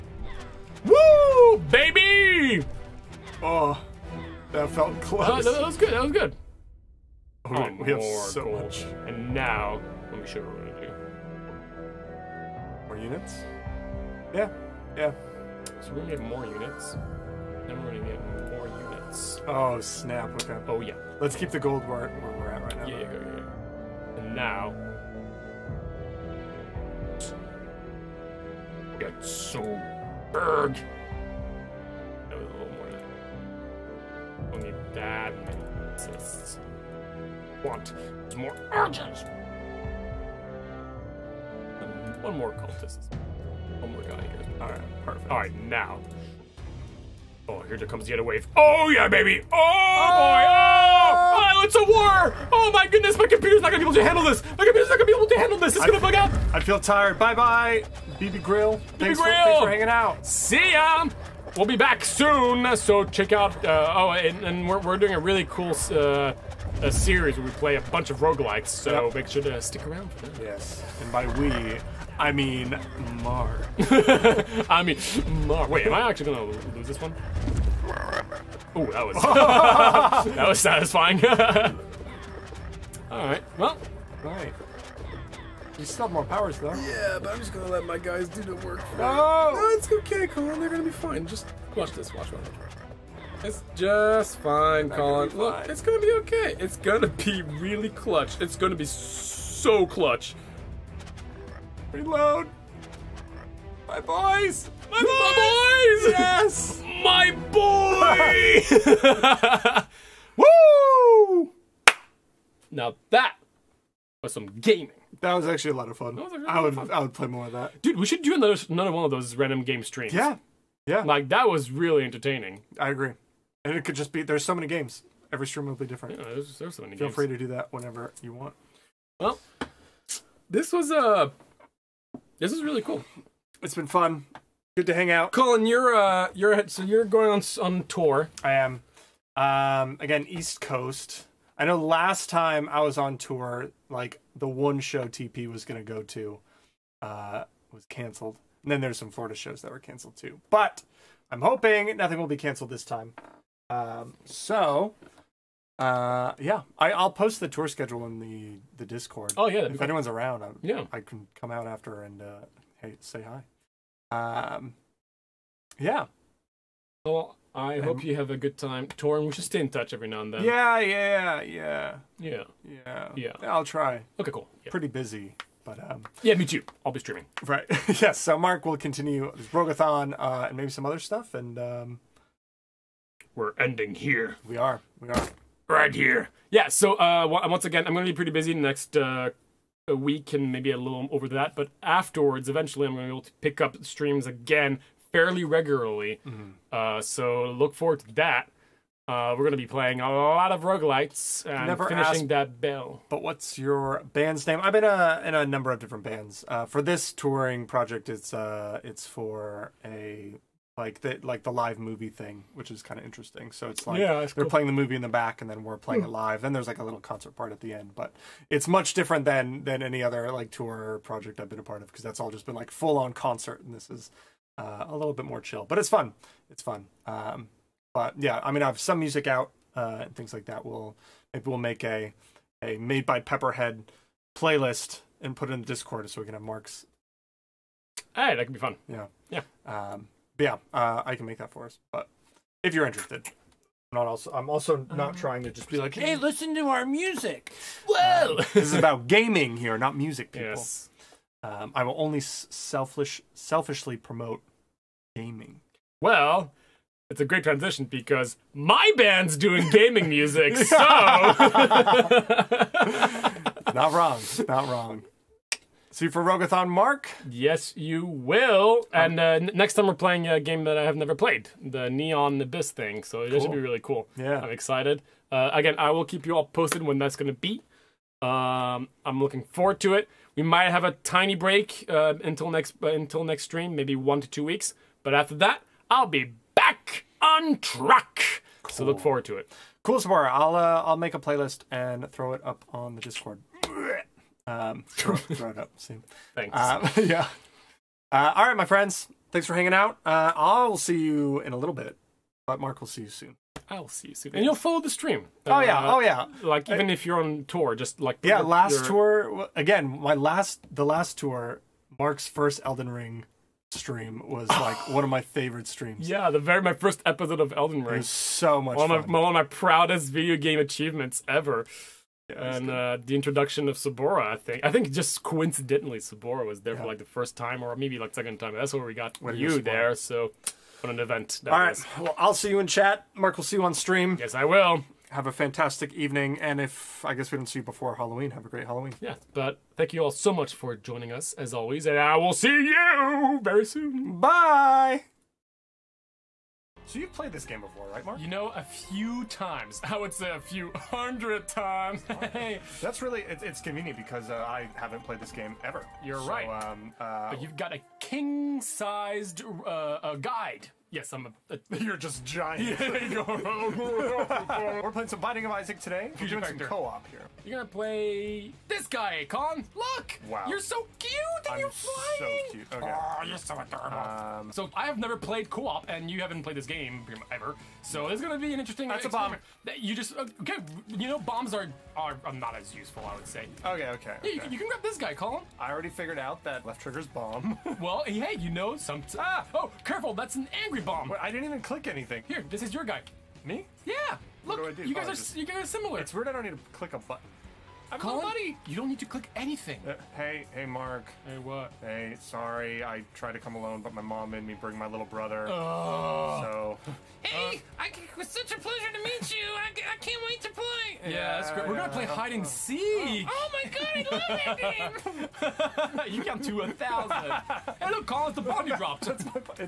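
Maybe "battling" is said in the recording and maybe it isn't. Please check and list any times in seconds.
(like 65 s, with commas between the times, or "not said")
not said.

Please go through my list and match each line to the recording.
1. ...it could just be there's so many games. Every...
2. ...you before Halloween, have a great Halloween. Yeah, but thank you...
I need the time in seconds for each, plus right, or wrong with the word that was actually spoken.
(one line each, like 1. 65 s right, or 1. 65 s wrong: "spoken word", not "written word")
1. 123 s right
2. 337 s right.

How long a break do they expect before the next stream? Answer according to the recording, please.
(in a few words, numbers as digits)
one to two weeks.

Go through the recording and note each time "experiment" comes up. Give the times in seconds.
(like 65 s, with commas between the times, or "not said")
379 s.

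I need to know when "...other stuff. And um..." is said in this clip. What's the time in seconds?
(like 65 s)
180 s.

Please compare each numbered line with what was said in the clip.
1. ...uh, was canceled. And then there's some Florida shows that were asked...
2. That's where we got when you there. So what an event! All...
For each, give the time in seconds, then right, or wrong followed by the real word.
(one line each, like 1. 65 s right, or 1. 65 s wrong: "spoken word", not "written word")
1. 147 s wrong: "canceled", not "asked"
2. 328 s right.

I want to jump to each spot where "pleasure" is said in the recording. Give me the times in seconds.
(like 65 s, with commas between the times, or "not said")
408 s.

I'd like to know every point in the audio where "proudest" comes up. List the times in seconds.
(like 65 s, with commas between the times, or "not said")
319 s.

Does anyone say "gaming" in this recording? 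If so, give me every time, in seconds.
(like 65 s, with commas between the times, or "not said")
114 s, 249 s, 255 s, 259 s.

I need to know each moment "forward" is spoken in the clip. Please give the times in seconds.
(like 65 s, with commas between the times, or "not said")
197 s, 279 s, 288 s.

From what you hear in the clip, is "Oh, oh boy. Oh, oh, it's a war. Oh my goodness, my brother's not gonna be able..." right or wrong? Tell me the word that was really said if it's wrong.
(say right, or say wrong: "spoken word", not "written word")
wrong: "computer", not "brother".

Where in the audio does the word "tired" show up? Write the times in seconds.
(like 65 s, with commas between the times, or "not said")
56 s.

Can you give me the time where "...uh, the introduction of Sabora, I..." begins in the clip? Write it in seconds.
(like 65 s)
322 s.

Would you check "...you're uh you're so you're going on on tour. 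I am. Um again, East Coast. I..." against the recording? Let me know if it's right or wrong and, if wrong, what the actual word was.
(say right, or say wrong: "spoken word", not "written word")
right.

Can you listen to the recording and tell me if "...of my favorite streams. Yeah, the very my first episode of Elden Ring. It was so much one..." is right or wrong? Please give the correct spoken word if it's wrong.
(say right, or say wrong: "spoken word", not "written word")
right.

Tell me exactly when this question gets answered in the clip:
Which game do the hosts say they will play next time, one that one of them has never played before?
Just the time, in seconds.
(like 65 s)
271 s.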